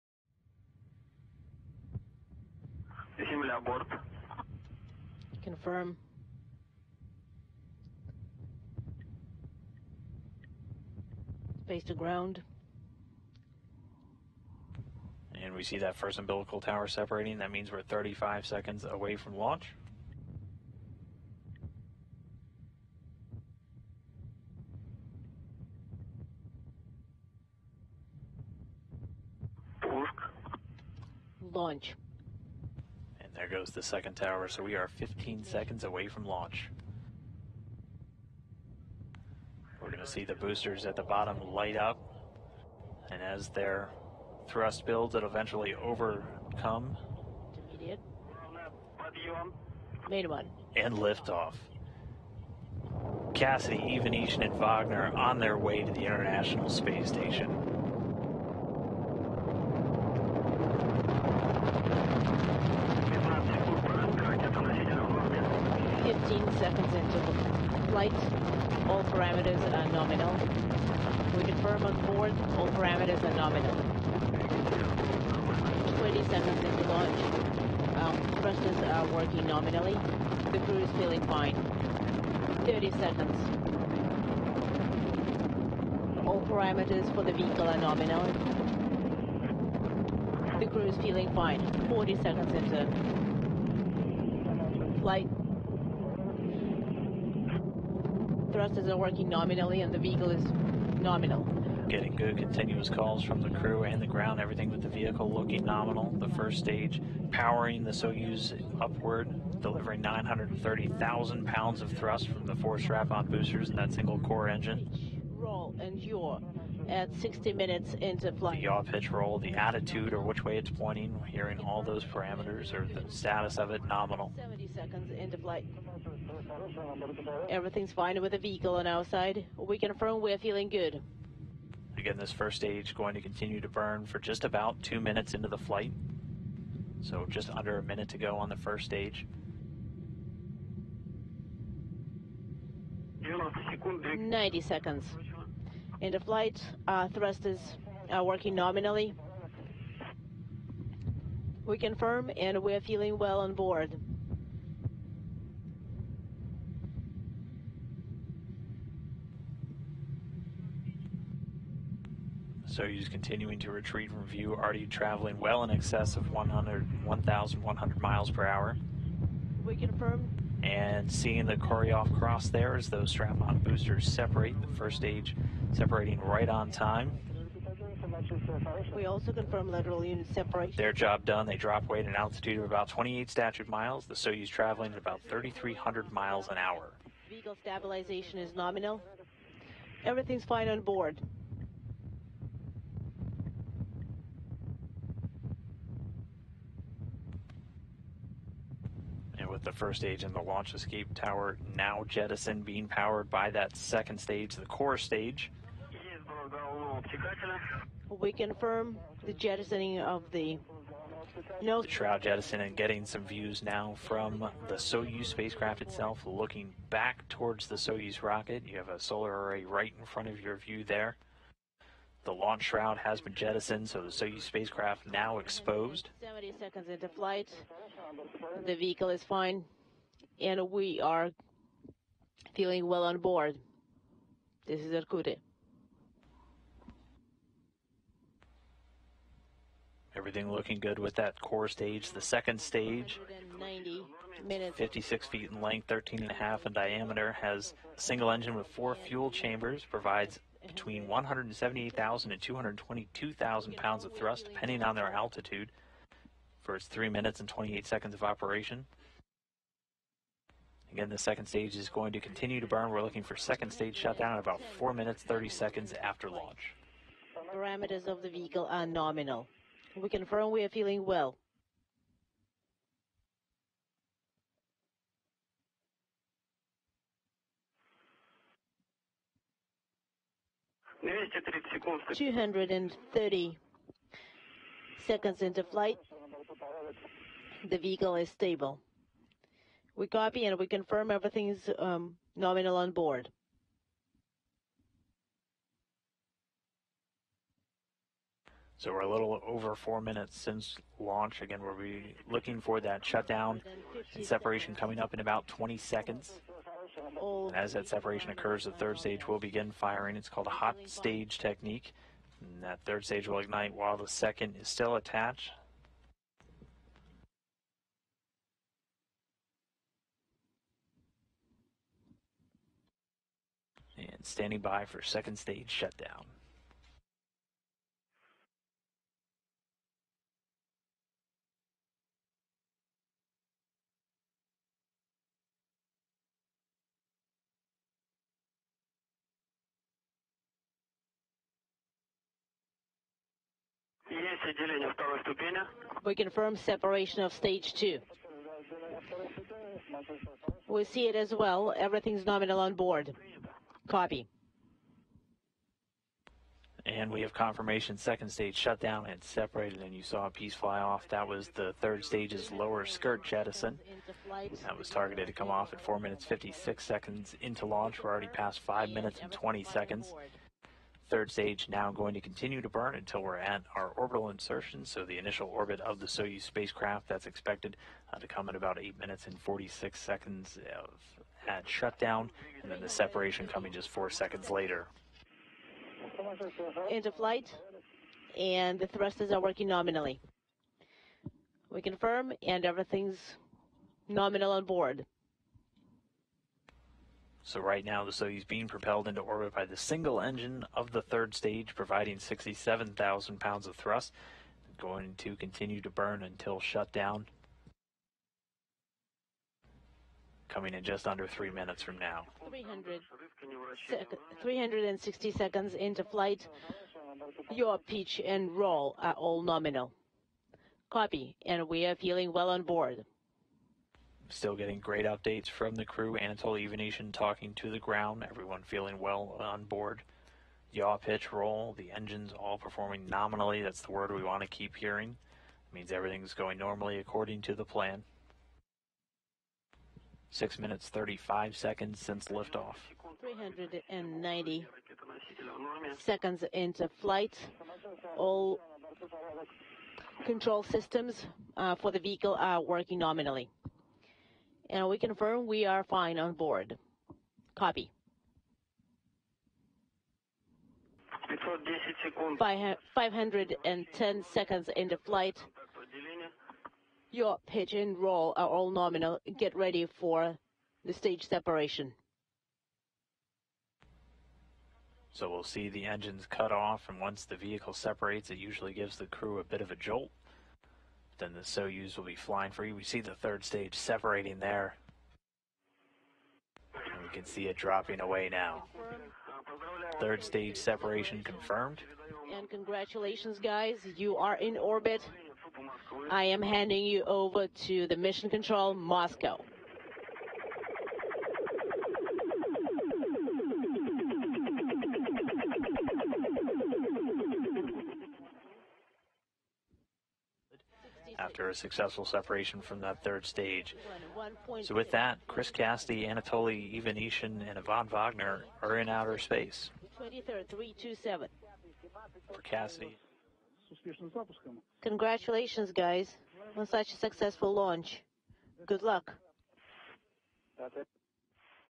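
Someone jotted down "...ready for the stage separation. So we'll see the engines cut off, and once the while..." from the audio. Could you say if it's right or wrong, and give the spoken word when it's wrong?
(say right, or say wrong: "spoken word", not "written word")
wrong: "vehicle", not "while".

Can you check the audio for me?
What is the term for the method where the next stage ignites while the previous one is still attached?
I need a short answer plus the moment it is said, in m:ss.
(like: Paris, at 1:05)
hot stage technique, at 5:10.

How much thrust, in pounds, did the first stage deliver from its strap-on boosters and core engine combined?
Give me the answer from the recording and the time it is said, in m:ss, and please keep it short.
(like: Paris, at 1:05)
930,000 pounds, at 1:50.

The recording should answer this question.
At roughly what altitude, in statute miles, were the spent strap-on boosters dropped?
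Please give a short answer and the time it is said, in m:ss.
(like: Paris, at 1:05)
28 statute miles, at 3:02.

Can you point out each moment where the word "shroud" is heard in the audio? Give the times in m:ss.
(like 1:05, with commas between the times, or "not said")
3:31, 3:42.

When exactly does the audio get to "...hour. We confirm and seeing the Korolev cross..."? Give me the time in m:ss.
2:48.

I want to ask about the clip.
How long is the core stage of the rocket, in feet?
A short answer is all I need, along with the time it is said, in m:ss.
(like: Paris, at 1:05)
56 feet, at 4:04.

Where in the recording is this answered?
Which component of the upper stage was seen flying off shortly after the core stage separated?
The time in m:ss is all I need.
6:02.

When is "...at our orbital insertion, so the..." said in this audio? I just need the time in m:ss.
6:13.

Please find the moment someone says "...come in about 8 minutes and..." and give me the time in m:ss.
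6:18.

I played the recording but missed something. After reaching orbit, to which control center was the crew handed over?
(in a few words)
Mission Control Moscow.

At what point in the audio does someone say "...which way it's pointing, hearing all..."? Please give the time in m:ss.
2:00.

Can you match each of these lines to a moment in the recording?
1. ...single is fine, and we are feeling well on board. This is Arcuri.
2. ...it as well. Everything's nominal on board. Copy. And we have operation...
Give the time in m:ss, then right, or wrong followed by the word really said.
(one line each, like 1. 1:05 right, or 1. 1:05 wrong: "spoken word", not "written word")
1. 3:48 wrong: "vehicle", not "single"
2. 5:51 wrong: "confirmation", not "operation".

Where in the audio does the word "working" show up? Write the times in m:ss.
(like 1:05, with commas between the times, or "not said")
1:19, 1:38, 2:28, 6:29, 7:32.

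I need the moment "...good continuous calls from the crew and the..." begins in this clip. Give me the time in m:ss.
1:42.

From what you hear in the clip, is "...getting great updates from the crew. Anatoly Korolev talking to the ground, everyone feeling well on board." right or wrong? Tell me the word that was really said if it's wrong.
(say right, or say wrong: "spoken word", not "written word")
wrong: "Ivanishin", not "Korolev".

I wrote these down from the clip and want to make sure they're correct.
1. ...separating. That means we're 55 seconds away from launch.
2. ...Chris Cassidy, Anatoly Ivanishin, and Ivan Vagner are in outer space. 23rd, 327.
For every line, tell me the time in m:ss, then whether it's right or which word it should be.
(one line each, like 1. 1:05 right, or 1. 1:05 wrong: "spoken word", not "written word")
1. 0:16 wrong: "35", not "55"
2. 8:35 right.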